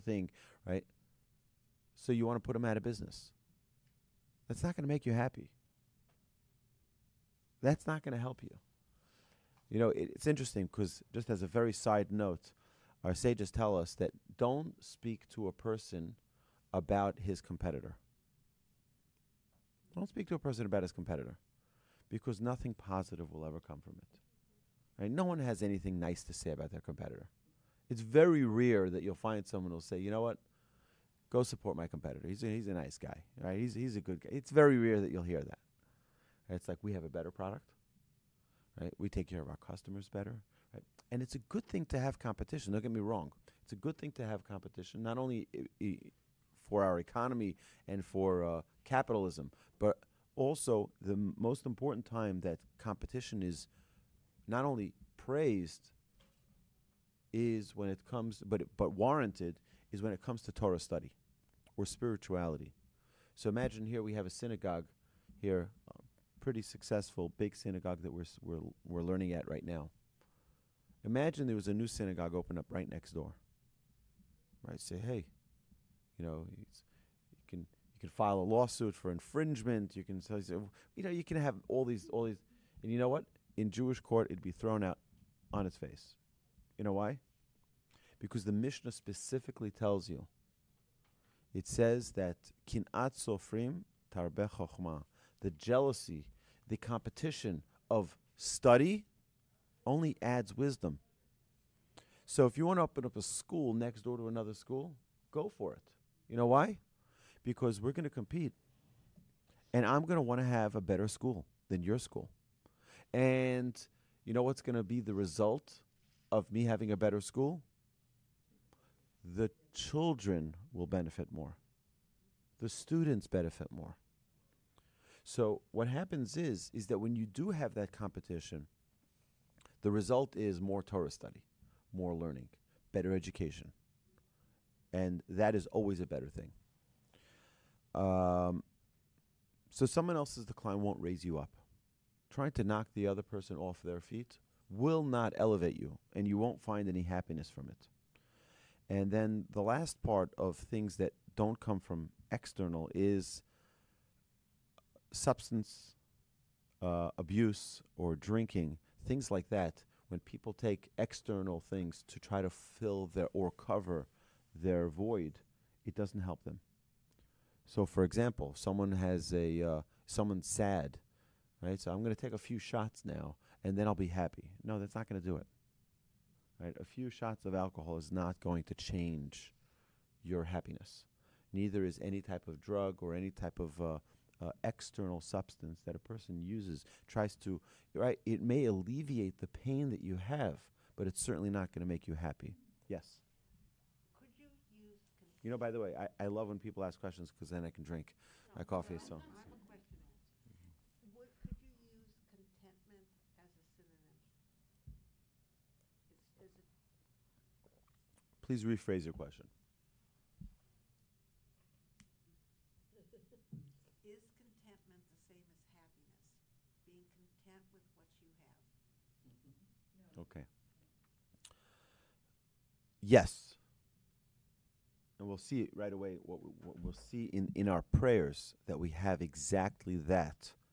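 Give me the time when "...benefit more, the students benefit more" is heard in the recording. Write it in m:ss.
2:00.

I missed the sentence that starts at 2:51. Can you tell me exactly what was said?
So I'm going to take a few shots now, and then I'll be happy.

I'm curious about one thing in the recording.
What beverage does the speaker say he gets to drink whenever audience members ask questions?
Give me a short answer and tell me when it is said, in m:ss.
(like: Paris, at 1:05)
Coffee, at 3:18.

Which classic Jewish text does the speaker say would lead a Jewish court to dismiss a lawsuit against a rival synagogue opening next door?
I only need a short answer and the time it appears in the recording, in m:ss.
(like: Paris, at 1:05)
The Mishnah, at 1:28.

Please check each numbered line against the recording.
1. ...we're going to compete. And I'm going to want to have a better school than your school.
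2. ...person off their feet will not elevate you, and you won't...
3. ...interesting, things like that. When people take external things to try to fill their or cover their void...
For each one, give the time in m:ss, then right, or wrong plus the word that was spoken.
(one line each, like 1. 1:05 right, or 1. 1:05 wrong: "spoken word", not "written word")
1. 1:47 right
2. 2:23 right
3. 2:38 wrong: "drinking", not "interesting".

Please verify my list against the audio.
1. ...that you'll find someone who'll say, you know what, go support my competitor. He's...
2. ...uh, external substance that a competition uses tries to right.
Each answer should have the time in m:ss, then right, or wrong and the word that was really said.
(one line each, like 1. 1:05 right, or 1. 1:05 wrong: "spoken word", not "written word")
1. 0:28 right
2. 3:04 wrong: "person", not "competition".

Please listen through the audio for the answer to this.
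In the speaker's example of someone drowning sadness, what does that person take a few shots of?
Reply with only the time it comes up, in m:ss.
2:57.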